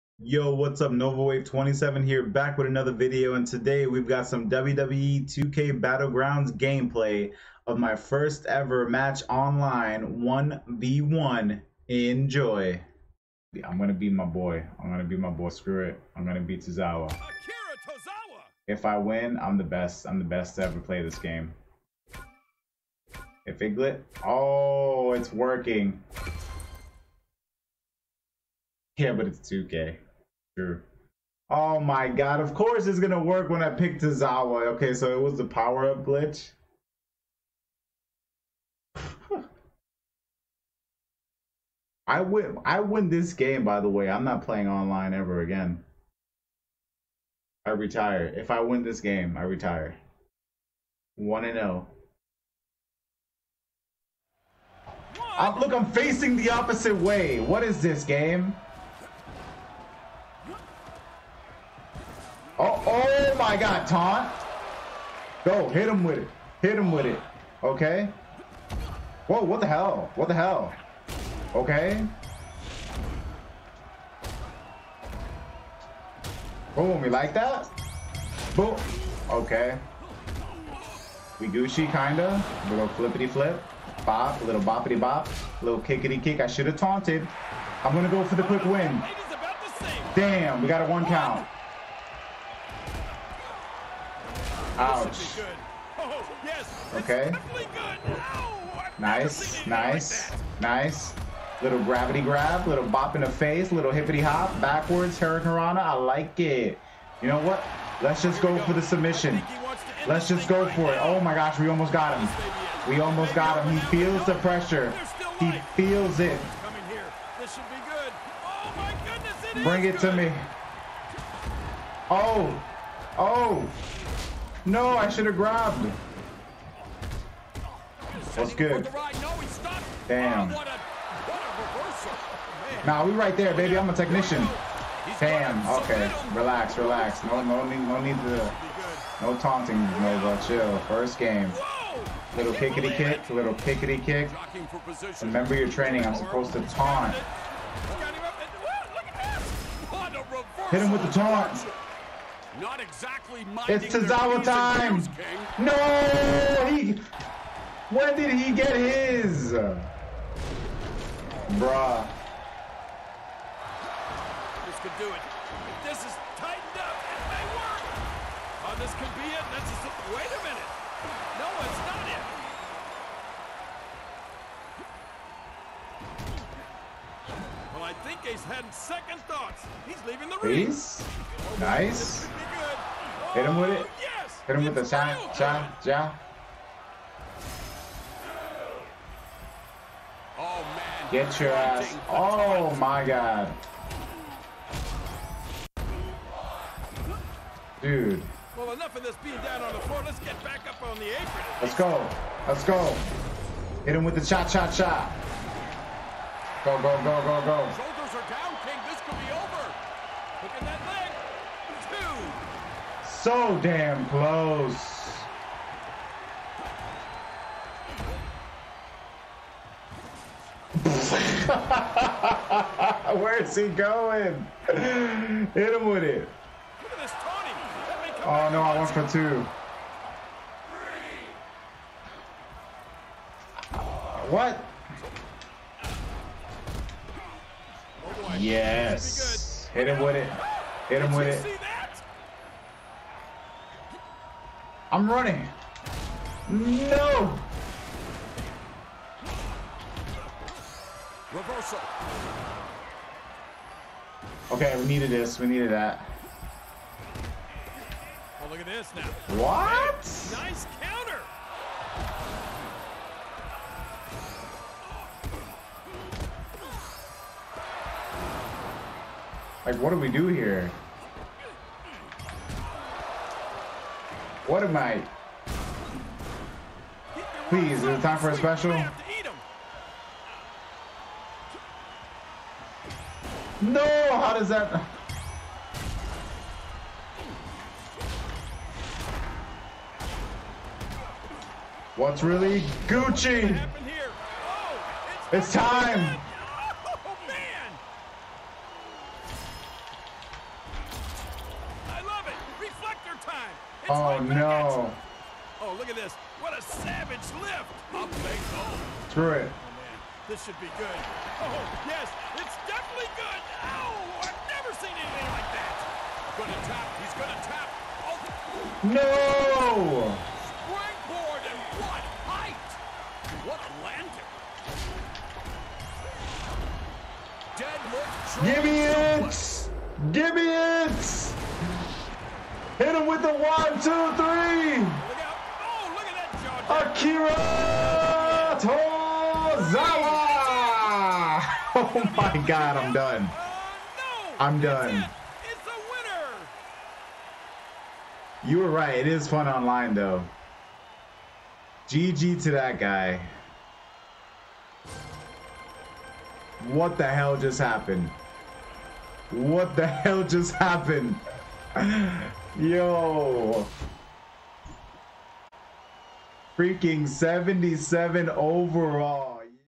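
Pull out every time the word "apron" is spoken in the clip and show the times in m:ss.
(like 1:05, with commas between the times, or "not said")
3:21.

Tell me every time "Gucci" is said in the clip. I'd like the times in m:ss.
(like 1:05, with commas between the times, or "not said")
1:21, 4:52.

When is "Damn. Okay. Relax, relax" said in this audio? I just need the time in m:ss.
2:15.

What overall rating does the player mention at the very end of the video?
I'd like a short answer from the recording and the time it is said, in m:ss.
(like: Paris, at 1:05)
77, at 6:07.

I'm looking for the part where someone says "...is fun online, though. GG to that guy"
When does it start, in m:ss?
5:49.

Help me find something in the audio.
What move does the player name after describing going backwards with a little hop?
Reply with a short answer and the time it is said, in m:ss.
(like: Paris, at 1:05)
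Hurricanrana, at 1:45.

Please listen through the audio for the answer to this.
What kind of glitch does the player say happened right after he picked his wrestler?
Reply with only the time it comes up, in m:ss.
0:35.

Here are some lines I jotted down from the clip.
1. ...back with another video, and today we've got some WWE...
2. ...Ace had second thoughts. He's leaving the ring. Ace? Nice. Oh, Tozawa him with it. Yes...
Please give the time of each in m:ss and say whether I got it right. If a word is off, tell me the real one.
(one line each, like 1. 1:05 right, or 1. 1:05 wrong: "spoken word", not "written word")
1. 0:02 right
2. 2:58 wrong: "Hit", not "Tozawa".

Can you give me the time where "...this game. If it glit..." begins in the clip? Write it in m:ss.
0:21.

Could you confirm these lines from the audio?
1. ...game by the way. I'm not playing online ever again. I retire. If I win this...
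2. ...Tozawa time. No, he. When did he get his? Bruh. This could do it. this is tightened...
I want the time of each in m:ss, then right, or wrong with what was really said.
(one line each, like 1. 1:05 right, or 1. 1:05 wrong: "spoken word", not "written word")
1. 0:43 right
2. 2:33 right.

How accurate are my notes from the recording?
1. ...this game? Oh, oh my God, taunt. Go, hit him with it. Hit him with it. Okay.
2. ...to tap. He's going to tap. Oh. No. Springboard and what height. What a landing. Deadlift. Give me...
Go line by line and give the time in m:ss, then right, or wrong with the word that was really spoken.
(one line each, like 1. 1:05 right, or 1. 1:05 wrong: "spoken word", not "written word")
1. 0:57 right
2. 5:16 right.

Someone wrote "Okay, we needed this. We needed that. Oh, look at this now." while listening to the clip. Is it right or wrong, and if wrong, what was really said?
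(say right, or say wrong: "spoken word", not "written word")
right.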